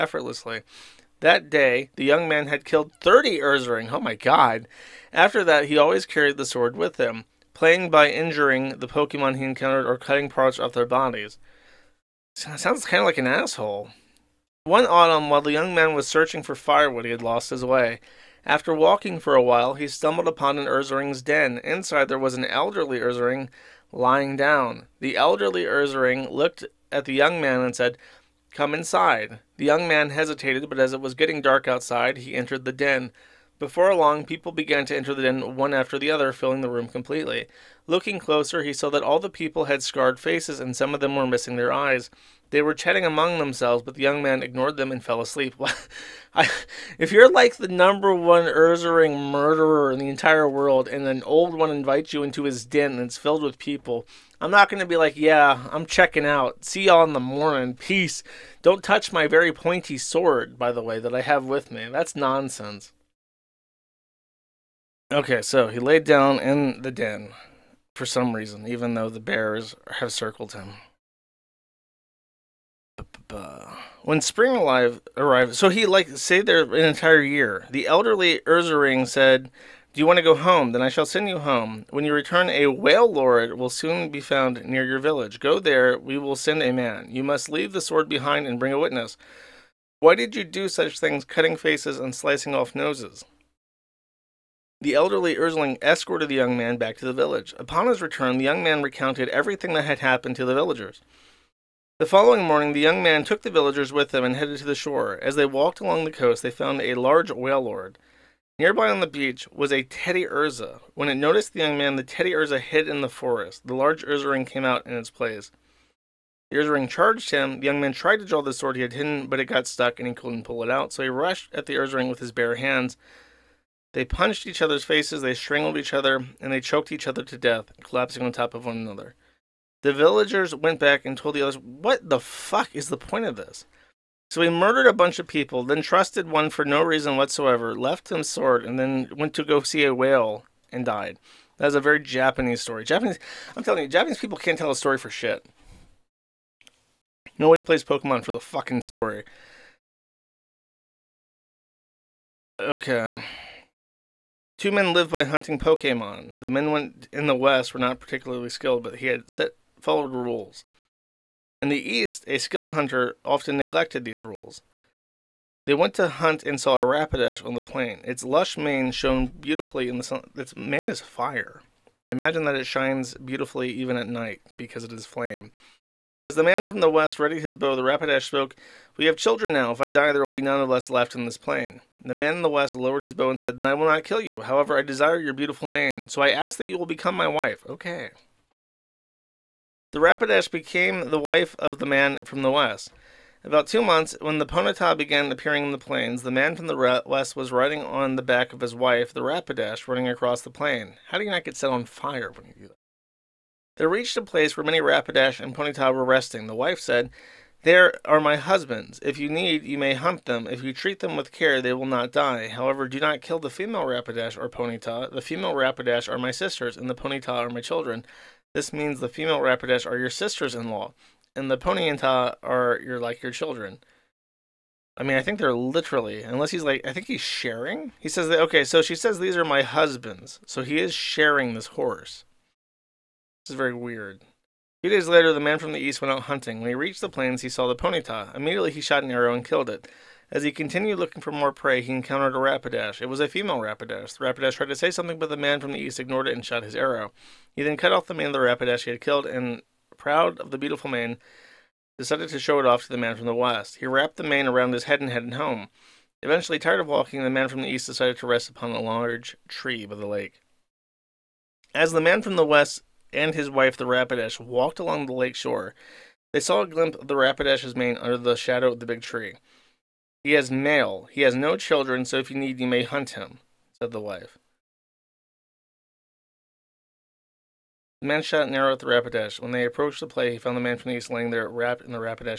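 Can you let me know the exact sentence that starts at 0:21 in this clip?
Inside, there was an elderly Ursaring lying down.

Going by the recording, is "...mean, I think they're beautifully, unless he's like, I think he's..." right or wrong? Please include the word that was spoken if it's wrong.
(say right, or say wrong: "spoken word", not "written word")
wrong: "literally", not "beautifully".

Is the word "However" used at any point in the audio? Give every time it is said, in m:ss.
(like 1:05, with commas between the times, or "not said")
3:04, 3:32.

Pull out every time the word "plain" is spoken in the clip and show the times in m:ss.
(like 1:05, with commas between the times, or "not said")
2:47, 3:01, 3:15, 3:20, 3:57.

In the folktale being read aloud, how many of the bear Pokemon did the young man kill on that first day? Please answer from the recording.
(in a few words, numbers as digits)
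30.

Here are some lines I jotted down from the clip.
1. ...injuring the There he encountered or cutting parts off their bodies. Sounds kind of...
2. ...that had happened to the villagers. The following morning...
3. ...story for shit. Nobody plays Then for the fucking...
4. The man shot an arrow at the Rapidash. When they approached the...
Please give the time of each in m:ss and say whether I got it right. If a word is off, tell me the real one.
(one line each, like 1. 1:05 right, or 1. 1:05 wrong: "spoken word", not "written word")
1. 0:08 wrong: "Pokemon", not "There"
2. 1:39 right
3. 2:24 wrong: "Pokemon", not "Then"
4. 4:38 right.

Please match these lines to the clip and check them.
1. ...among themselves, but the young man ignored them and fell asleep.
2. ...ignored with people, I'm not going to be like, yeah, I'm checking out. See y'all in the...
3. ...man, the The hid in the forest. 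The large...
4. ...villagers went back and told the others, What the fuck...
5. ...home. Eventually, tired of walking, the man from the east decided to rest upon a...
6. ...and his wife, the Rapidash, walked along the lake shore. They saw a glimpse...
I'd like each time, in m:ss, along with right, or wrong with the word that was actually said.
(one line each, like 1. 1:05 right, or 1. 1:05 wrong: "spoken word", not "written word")
1. 0:43 right
2. 0:53 wrong: "filled", not "ignored"
3. 1:51 wrong: "Teddiursa", not "The"
4. 2:09 right
5. 4:15 right
6. 4:23 right.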